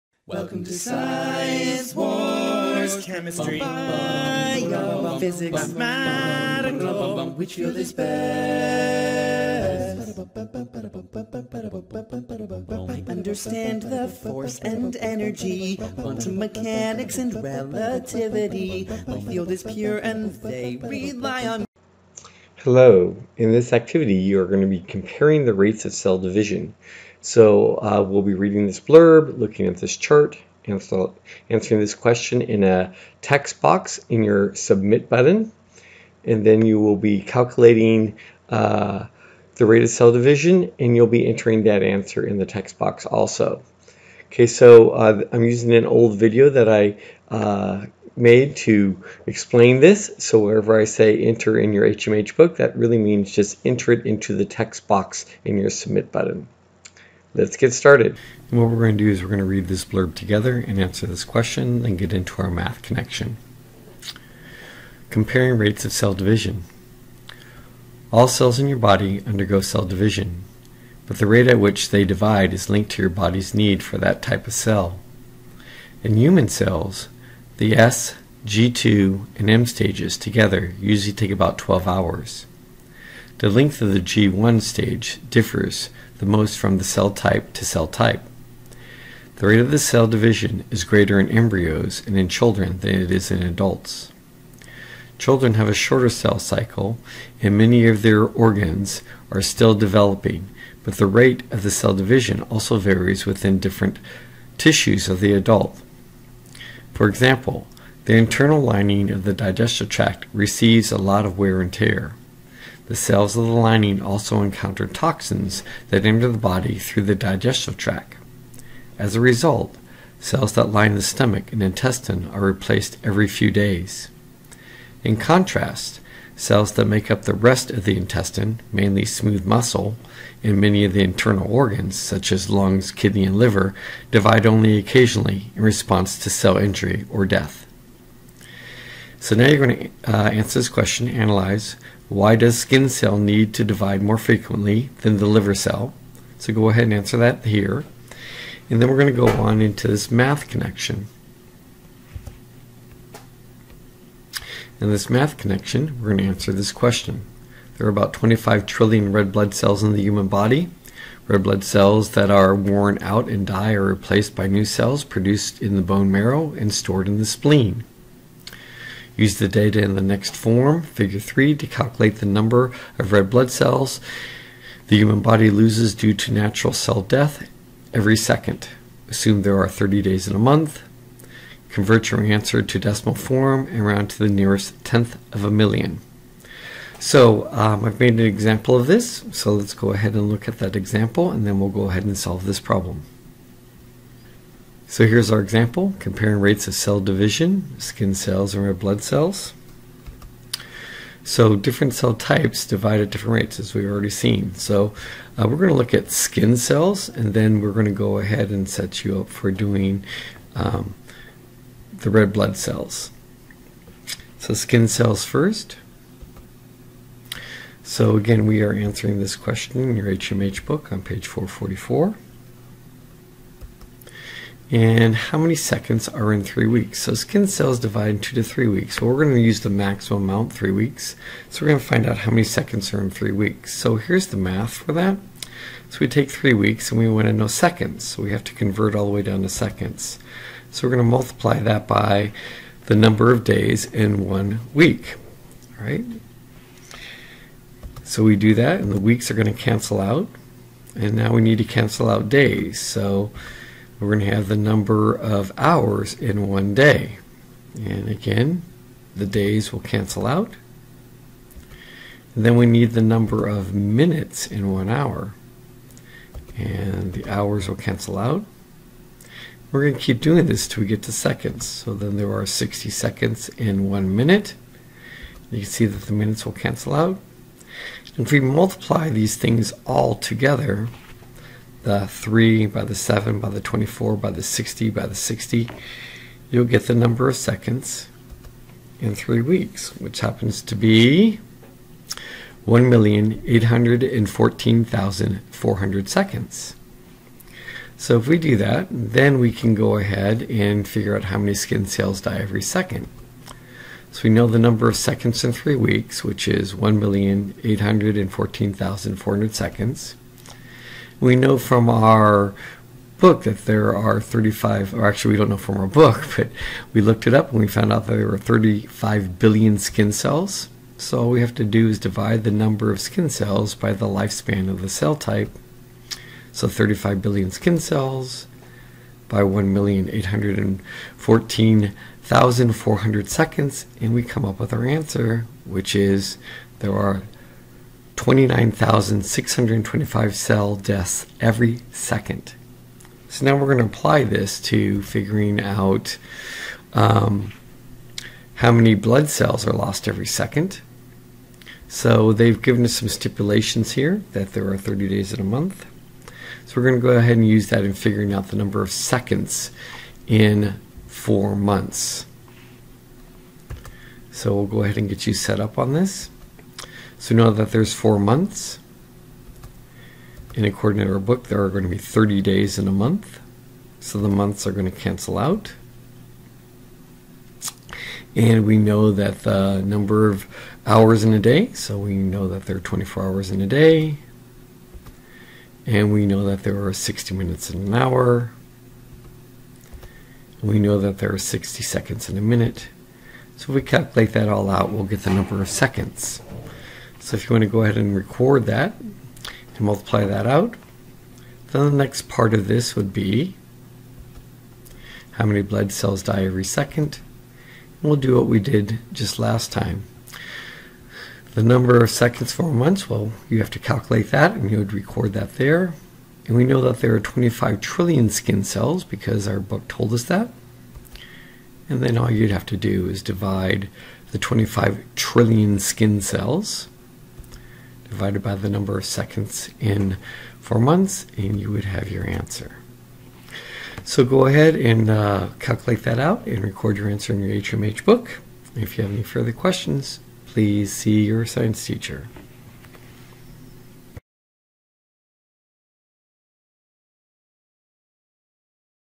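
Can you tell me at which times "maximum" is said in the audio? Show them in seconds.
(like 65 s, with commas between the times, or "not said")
229 s.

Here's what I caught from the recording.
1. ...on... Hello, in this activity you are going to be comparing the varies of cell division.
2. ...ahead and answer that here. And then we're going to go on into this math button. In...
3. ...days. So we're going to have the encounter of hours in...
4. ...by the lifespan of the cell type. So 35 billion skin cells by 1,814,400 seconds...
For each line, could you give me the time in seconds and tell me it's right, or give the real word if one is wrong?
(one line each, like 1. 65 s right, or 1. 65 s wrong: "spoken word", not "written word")
1. 21 s wrong: "rates", not "varies"
2. 146 s wrong: "connection", not "button"
3. 252 s wrong: "number", not "encounter"
4. 323 s right.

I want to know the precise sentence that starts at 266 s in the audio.
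And the hours will cancel out.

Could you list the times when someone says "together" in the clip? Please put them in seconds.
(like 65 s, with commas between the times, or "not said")
60 s, 80 s, 280 s.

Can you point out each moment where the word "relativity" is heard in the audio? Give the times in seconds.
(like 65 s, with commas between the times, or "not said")
17 s.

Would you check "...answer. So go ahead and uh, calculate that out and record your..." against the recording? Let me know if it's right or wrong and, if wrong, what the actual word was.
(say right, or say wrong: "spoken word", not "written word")
right.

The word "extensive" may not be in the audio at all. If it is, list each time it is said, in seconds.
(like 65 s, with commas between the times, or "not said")
not said.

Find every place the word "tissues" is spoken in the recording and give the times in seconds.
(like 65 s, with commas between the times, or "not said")
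104 s.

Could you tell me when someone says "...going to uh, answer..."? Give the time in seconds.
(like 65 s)
139 s.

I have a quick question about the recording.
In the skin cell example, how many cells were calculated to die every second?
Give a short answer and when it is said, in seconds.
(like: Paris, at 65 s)
29,625, at 338 s.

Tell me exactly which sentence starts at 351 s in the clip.
So they've given us some stipulations here that there are 30 days in a month.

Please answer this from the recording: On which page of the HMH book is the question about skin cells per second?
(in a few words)
444.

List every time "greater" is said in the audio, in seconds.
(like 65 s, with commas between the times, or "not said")
90 s.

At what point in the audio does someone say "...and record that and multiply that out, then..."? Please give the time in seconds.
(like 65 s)
397 s.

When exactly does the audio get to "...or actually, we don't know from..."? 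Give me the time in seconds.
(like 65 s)
314 s.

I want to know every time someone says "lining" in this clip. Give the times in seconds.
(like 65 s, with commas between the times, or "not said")
108 s, 113 s.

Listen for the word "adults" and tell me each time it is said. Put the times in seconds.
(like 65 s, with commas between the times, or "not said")
93 s, 105 s.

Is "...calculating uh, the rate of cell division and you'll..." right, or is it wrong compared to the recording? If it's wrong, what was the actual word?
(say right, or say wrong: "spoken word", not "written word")
right.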